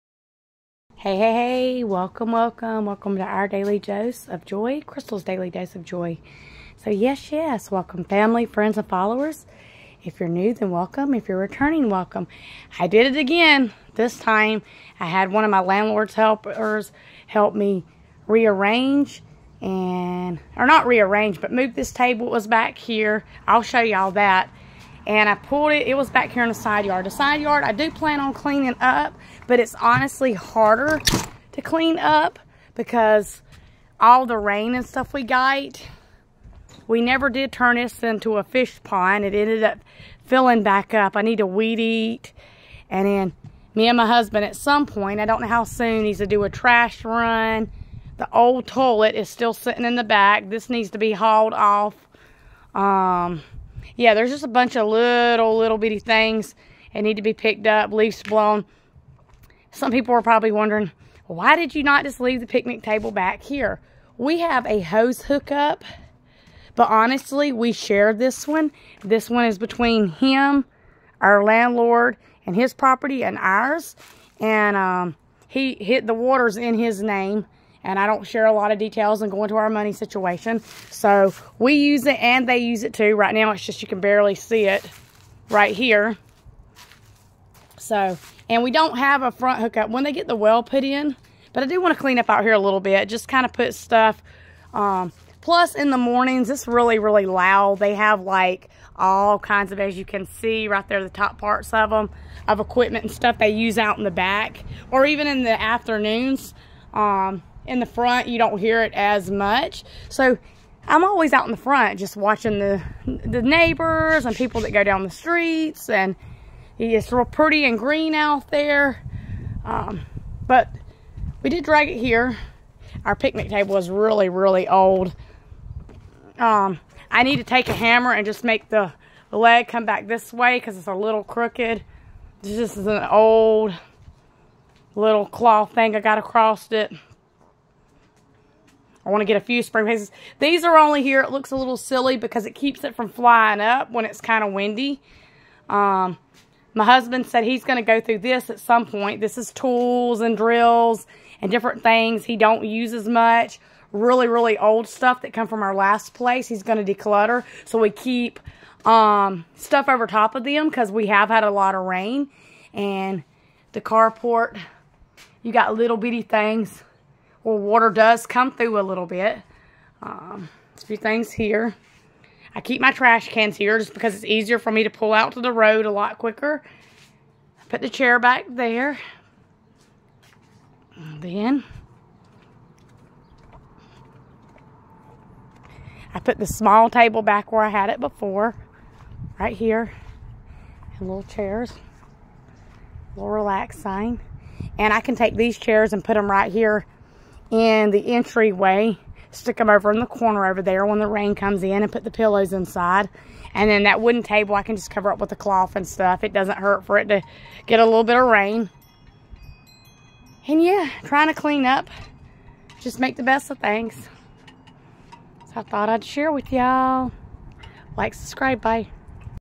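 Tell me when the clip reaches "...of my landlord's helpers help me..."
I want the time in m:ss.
0:15.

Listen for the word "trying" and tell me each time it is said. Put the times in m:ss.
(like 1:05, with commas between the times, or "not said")
3:31.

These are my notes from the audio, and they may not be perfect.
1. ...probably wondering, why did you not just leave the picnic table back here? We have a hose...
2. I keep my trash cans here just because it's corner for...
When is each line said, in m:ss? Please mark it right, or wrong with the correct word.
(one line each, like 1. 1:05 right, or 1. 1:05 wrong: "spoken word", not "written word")
1. 1:00 right
2. 2:52 wrong: "easier", not "corner".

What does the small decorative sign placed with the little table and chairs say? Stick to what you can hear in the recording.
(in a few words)
Relax.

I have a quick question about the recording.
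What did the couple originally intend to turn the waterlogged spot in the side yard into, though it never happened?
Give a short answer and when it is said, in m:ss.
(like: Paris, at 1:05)
Fish pond, at 0:38.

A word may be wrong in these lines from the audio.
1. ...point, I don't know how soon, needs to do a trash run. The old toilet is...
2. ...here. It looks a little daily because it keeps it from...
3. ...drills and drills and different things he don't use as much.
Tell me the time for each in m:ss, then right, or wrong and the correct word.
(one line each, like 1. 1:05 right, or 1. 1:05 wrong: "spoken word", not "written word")
1. 0:44 right
2. 2:21 wrong: "silly", not "daily"
3. 2:29 wrong: "tools", not "drills".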